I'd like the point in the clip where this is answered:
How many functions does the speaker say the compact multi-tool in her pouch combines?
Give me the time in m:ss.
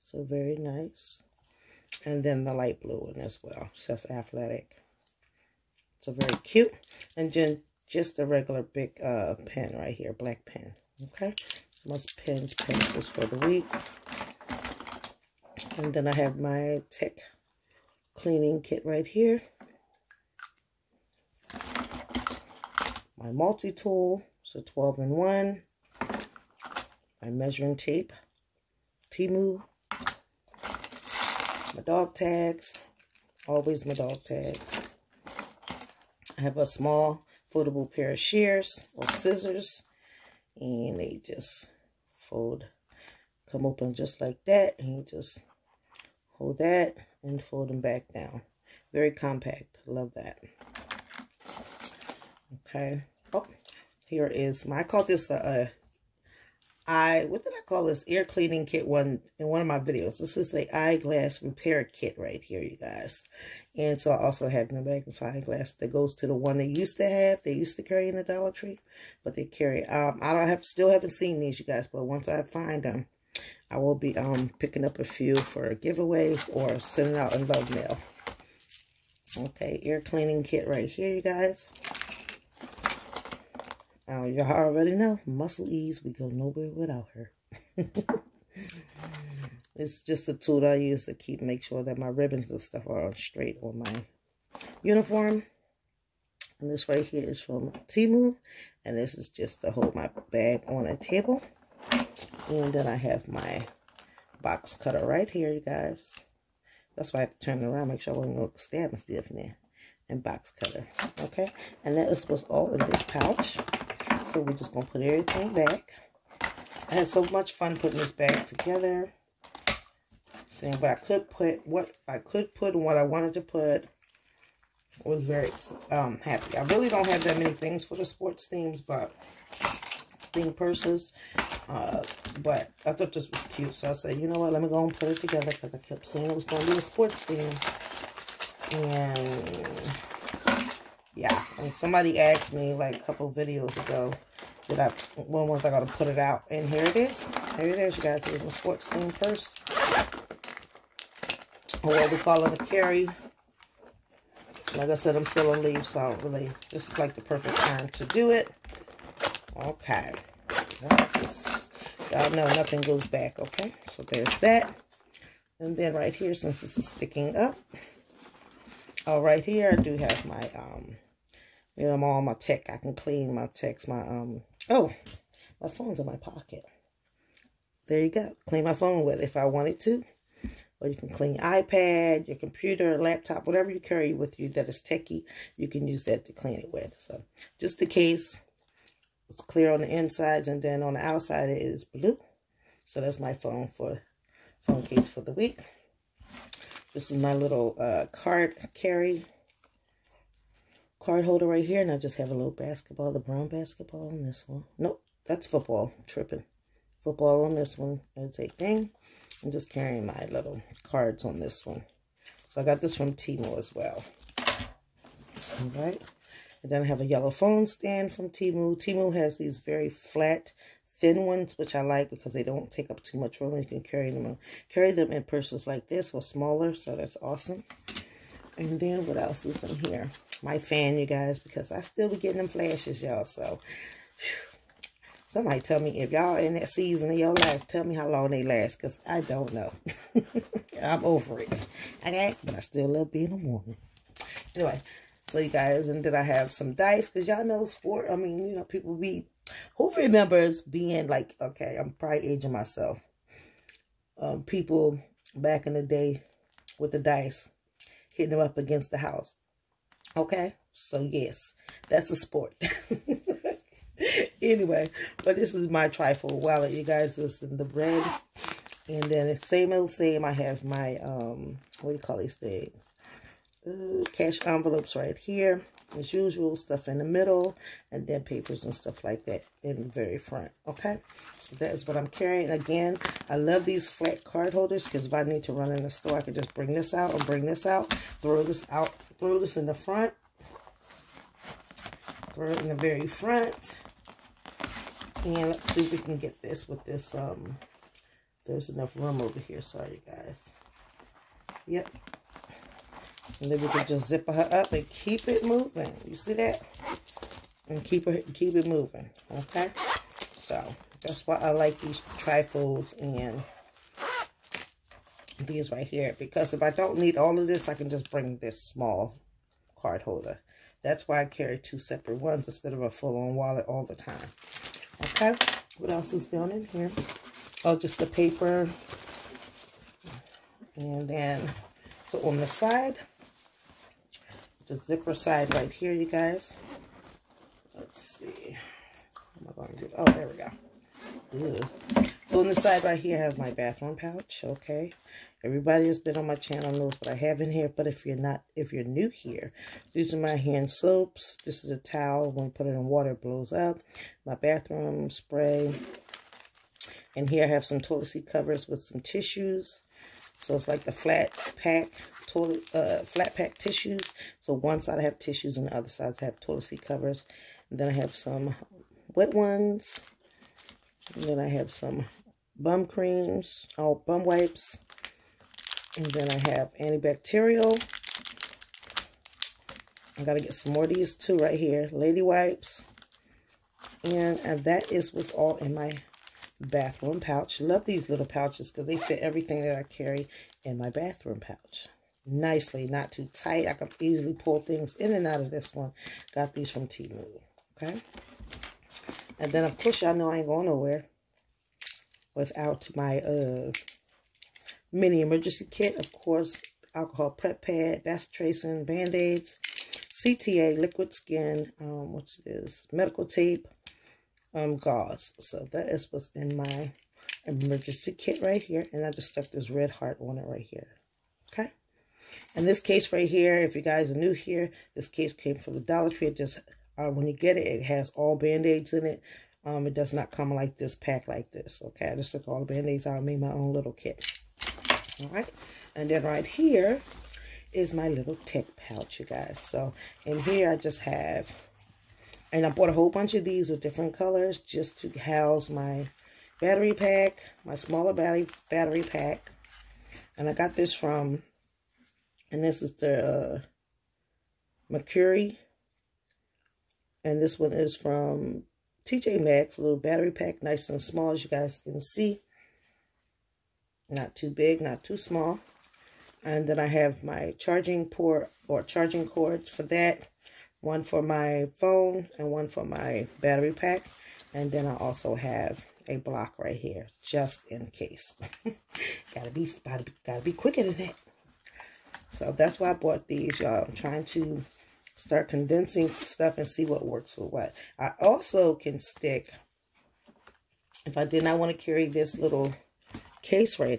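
0:24.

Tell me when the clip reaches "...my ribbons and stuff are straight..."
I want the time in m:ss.
1:31.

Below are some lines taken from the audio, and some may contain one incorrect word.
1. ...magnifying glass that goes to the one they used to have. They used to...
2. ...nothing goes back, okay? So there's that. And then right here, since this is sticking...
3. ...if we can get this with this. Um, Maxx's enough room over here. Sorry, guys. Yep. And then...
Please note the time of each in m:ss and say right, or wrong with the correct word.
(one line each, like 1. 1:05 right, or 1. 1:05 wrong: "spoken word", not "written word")
1. 1:04 right
2. 2:42 right
3. 4:55 wrong: "There", not "Maxx".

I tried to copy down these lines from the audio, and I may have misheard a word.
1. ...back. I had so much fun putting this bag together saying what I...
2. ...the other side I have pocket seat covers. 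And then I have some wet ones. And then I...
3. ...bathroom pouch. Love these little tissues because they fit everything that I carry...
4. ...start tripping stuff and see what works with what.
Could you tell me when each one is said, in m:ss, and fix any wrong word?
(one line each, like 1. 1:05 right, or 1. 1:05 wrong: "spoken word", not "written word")
1. 1:55 right
2. 6:05 wrong: "toilet", not "pocket"
3. 6:26 wrong: "pouches", not "tissues"
4. 8:05 wrong: "condensing", not "tripping".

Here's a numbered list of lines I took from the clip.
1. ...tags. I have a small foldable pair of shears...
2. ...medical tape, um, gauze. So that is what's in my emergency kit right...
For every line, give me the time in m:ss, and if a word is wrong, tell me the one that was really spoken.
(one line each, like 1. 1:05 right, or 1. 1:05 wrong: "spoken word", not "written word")
1. 0:34 right
2. 6:52 right.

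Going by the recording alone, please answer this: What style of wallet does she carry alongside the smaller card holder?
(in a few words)
trifold wallet.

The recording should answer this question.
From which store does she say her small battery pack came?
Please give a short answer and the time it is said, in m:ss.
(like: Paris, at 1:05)
TJ Maxx, at 7:39.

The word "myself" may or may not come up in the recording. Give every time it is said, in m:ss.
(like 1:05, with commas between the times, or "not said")
1:48, 4:12.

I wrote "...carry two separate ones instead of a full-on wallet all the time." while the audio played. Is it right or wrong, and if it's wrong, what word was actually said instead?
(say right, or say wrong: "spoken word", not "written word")
right.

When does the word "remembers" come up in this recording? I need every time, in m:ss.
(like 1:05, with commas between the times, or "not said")
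4:09.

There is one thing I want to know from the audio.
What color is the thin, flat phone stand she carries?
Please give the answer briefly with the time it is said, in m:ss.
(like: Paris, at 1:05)
yellow, at 3:37.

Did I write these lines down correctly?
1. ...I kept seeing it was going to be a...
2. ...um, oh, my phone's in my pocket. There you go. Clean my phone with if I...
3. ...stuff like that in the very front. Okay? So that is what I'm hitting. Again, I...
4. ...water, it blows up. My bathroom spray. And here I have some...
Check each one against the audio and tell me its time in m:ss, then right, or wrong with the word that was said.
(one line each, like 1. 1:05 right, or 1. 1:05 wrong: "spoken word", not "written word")
1. 2:15 right
2. 2:54 right
3. 4:38 wrong: "carrying", not "hitting"
4. 5:52 right.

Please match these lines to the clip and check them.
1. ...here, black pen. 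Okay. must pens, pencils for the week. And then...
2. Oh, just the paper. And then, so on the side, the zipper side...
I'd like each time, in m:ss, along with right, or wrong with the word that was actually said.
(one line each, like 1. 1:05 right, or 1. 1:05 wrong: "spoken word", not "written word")
1. 0:09 right
2. 5:27 right.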